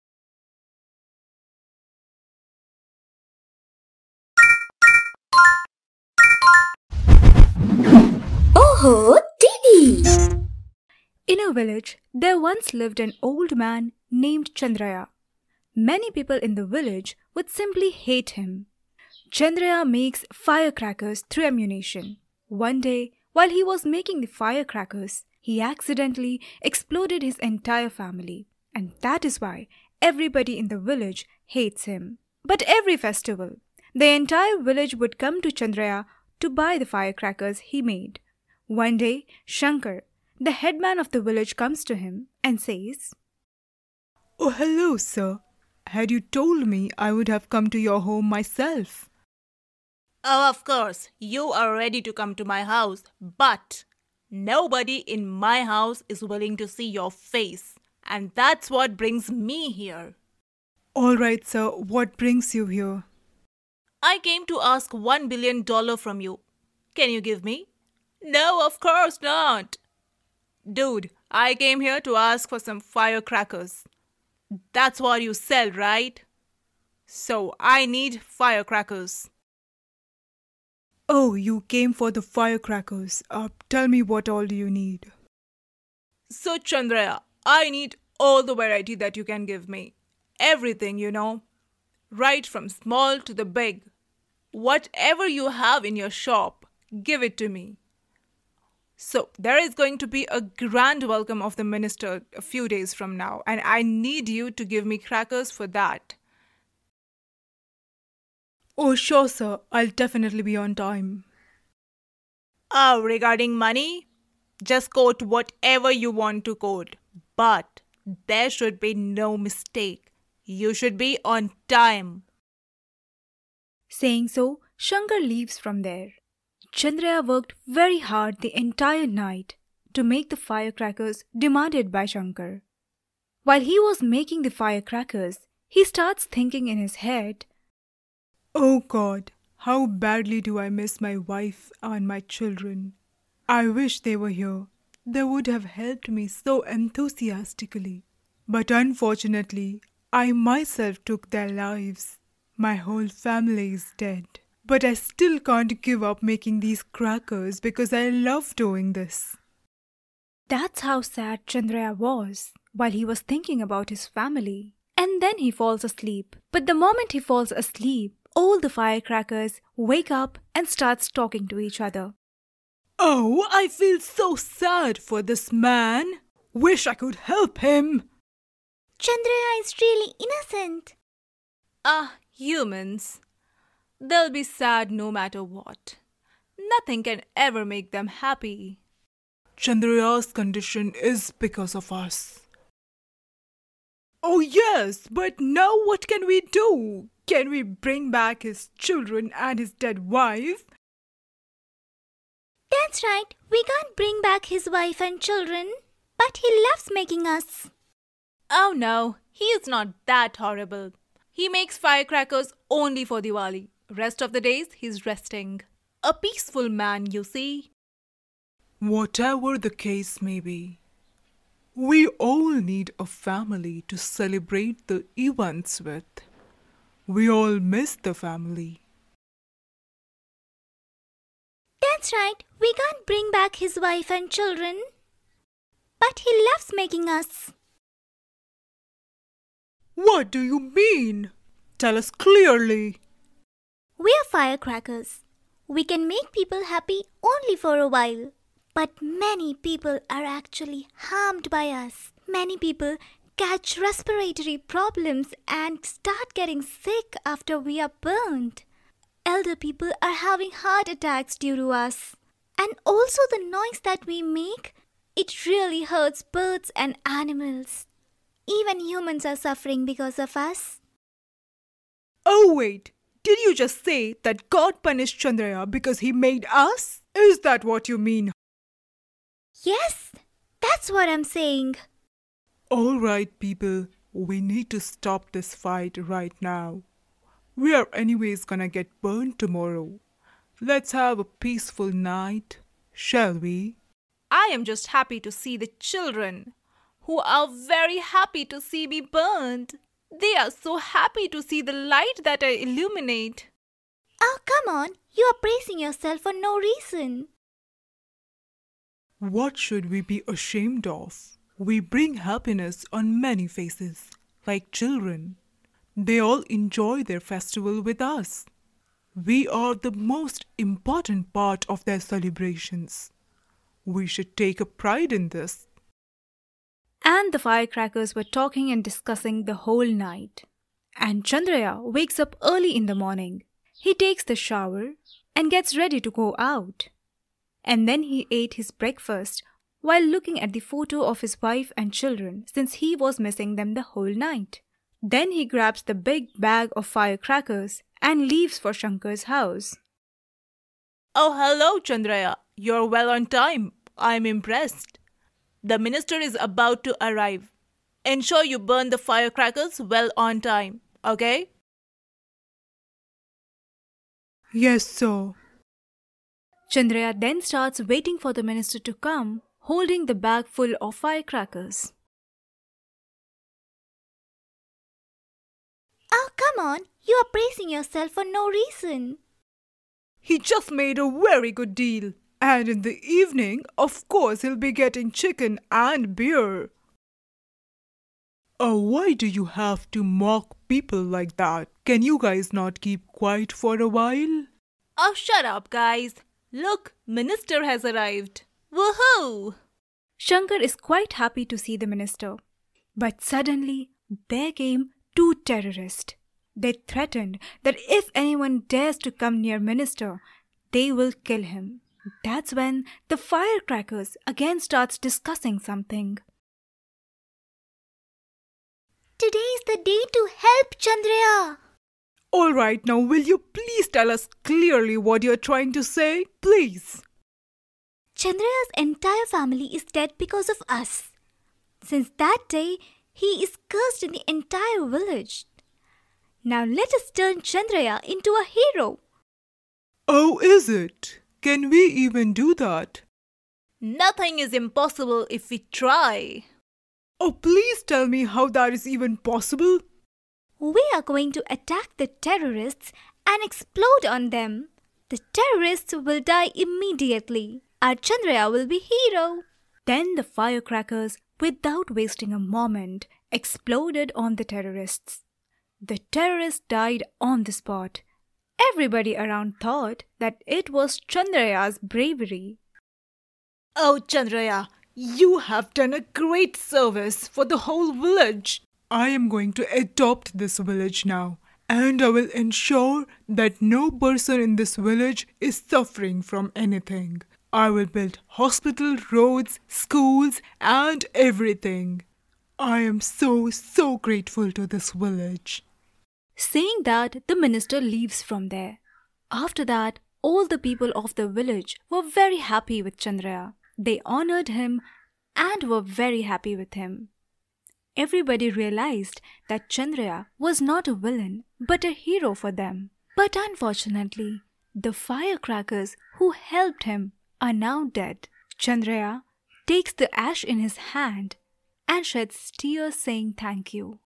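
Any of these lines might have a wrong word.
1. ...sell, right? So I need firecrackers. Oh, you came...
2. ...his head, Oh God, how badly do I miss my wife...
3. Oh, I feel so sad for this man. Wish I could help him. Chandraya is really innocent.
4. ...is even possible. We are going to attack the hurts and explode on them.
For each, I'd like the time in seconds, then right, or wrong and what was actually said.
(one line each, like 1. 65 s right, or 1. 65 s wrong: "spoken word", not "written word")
1. 75 s right
2. 136 s right
3. 172 s right
4. 448 s wrong: "terrorists", not "hurts".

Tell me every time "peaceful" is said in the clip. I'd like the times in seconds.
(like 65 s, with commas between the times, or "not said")
216 s, 291 s.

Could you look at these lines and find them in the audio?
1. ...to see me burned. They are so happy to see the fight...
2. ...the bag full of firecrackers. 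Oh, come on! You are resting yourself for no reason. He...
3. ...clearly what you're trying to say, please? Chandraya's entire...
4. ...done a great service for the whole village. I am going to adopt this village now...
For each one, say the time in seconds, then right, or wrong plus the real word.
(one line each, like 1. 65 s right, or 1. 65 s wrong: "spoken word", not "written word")
1. 298 s wrong: "light", not "fight"
2. 370 s wrong: "praising", not "resting"
3. 424 s right
4. 475 s right.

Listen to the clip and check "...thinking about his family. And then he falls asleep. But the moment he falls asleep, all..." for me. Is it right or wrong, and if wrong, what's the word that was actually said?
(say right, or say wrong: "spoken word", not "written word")
right.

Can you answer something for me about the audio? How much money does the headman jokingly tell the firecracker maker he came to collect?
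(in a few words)
one billion dollar.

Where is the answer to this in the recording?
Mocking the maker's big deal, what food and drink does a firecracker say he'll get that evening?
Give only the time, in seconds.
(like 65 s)
385 s.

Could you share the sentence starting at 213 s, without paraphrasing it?
Rest of the days, he's resting.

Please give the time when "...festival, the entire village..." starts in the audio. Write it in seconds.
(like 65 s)
32 s.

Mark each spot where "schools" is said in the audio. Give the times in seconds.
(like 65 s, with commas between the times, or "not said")
489 s.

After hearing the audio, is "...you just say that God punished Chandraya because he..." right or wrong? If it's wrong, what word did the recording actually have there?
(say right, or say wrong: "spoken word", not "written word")
right.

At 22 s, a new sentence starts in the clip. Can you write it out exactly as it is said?
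One day, while he was making the firecrackers, he accidentally exploded his entire family.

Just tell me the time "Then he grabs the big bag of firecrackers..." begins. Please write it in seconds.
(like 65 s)
345 s.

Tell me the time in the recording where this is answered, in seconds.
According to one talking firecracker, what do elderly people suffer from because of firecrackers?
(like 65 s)
260 s.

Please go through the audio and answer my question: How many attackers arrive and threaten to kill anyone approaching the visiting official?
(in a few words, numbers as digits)
2.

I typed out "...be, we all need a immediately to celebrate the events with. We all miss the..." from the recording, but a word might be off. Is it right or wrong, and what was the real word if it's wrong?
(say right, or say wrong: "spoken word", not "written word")
wrong: "family", not "immediately".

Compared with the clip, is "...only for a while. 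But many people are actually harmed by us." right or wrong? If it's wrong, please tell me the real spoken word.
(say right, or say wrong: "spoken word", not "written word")
right.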